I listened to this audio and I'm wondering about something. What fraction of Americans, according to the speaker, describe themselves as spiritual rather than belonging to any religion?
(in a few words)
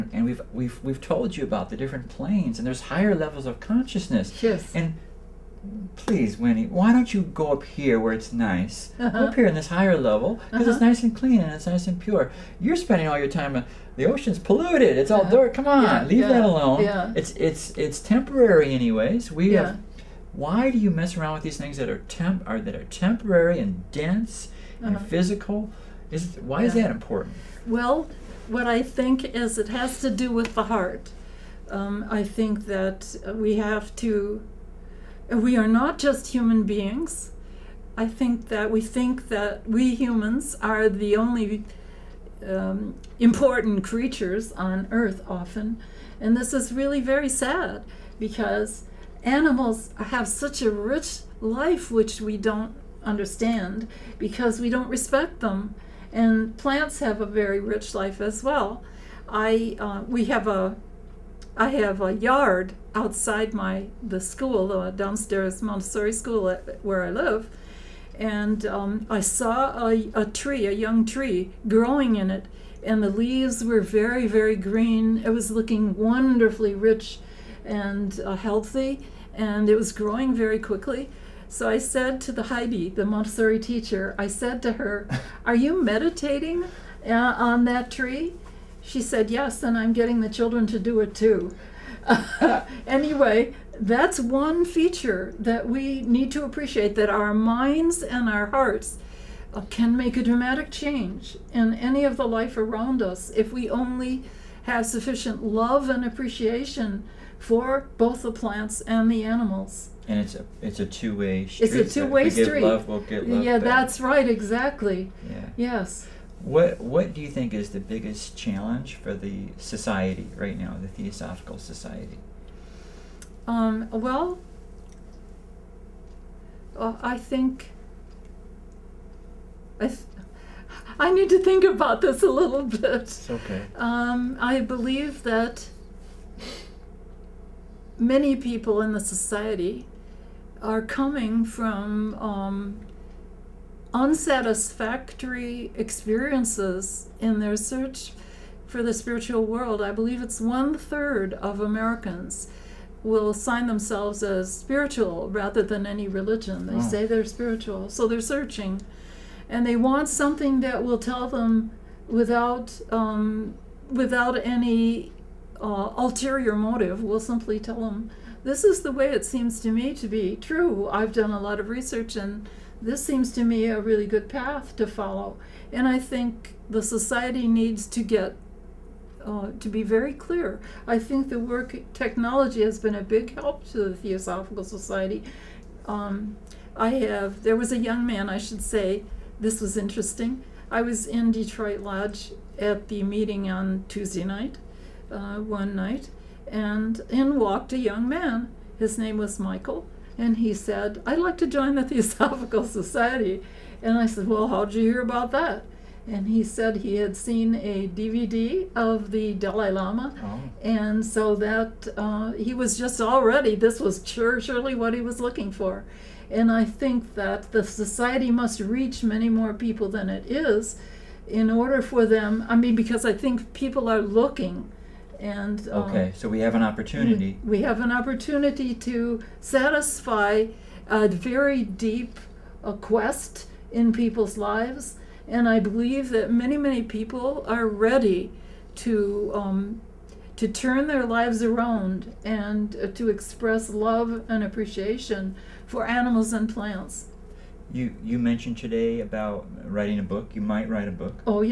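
One third.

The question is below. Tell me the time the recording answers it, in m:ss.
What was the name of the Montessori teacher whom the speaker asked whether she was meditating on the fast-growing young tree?
1:22.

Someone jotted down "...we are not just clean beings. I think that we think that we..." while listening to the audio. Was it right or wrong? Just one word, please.
wrong.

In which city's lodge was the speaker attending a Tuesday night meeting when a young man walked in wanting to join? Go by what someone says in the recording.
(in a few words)
Detroit.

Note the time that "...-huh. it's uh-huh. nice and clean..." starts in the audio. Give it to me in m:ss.
0:10.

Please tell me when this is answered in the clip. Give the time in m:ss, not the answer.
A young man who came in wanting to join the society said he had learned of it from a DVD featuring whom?
3:29.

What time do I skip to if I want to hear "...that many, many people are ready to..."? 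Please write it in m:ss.
3:56.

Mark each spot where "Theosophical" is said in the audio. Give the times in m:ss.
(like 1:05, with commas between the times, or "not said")
2:00, 3:03, 3:21.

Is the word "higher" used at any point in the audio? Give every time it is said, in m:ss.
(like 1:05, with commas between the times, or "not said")
0:02, 0:09.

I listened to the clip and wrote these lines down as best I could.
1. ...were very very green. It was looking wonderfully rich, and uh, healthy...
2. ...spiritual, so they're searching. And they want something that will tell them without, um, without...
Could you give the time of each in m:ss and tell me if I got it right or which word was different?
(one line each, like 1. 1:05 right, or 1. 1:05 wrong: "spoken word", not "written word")
1. 1:13 right
2. 2:37 right.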